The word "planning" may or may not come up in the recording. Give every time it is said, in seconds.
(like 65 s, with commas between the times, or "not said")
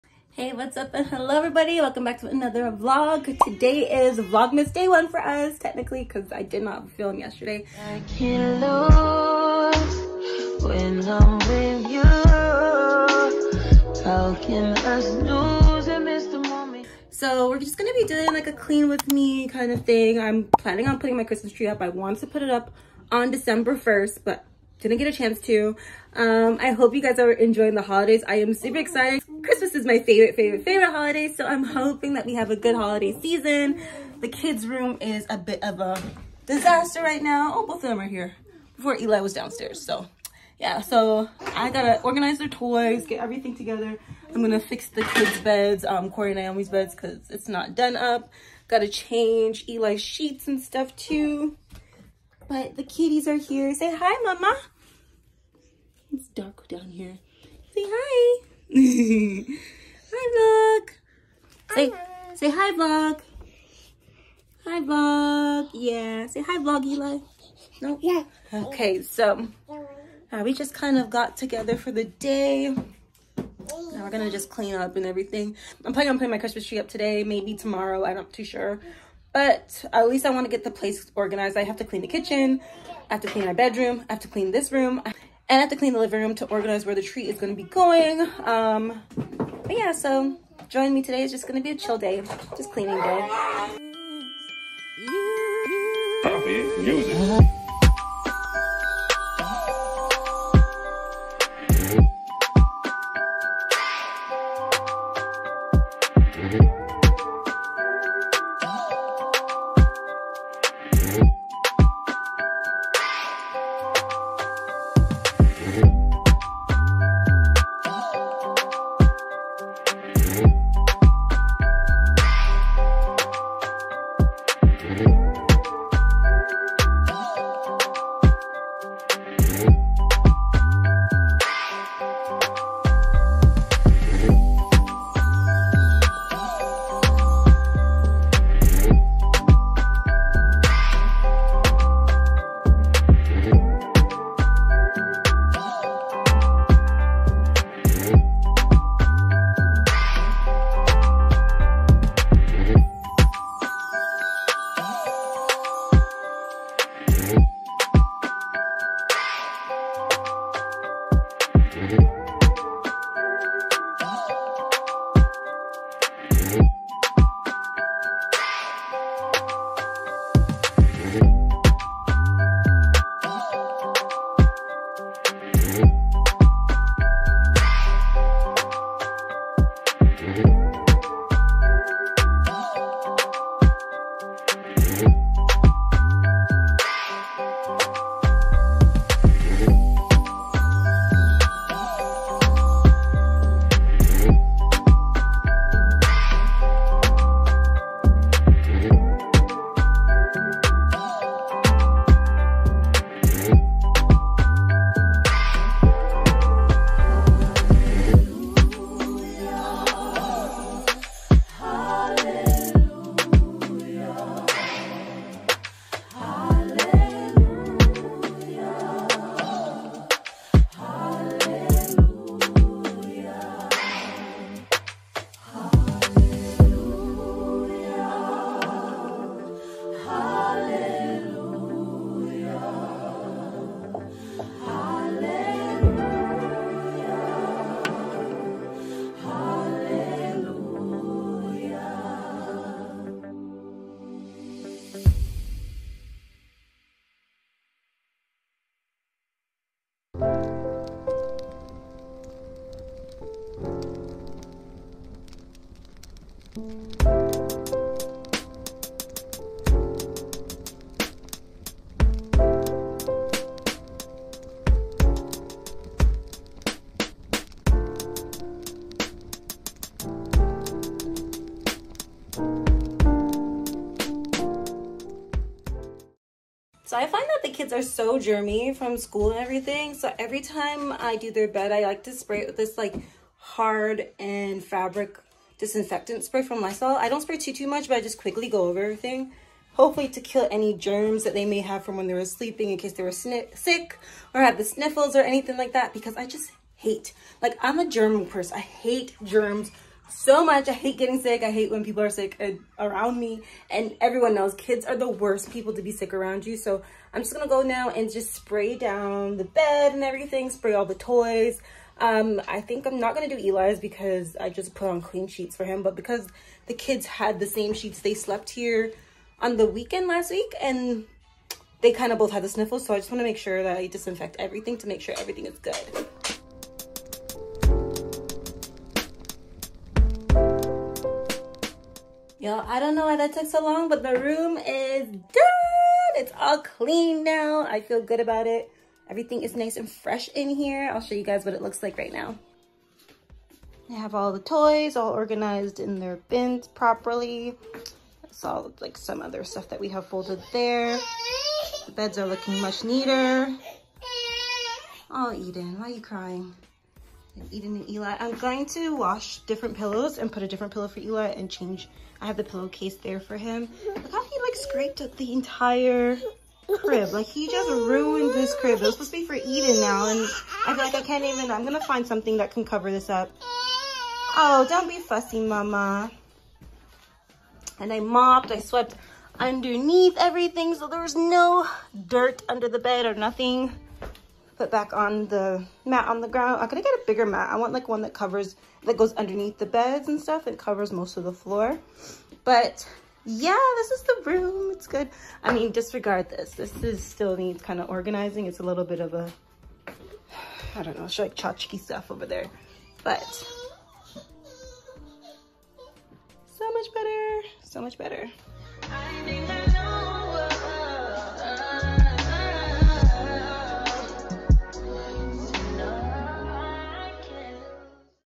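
20 s, 75 s.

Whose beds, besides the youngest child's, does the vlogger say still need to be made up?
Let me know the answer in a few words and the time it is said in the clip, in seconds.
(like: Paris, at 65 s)
Corey and Naomi, at 46 s.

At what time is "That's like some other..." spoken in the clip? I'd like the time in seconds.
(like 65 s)
348 s.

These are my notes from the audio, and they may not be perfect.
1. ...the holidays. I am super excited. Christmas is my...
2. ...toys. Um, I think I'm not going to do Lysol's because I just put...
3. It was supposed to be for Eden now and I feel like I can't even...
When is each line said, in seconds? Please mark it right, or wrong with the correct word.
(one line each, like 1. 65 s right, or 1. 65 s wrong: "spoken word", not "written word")
1. 27 s right
2. 310 s wrong: "Eli", not "Lysol"
3. 368 s right.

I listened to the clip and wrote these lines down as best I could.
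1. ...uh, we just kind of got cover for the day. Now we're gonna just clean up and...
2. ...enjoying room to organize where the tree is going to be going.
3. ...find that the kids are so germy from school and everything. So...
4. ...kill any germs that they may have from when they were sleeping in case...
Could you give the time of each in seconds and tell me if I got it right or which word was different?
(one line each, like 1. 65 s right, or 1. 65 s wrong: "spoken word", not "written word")
1. 70 s wrong: "together", not "cover"
2. 85 s wrong: "living", not "enjoying"
3. 277 s right
4. 290 s right.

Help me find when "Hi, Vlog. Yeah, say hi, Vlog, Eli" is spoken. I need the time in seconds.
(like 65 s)
64 s.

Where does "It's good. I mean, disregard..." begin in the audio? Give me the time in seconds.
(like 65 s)
394 s.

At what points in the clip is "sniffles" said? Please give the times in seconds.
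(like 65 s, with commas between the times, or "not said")
294 s, 322 s.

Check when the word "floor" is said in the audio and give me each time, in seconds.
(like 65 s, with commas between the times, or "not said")
391 s.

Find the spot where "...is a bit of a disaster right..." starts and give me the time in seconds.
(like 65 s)
34 s.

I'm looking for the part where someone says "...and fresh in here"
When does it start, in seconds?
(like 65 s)
339 s.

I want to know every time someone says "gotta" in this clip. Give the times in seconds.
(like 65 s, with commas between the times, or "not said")
41 s, 48 s.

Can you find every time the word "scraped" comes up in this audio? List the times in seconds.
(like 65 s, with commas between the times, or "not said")
364 s.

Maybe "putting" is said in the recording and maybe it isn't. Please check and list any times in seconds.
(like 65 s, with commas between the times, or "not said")
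20 s, 76 s.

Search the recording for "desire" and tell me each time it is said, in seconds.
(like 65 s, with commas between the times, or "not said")
not said.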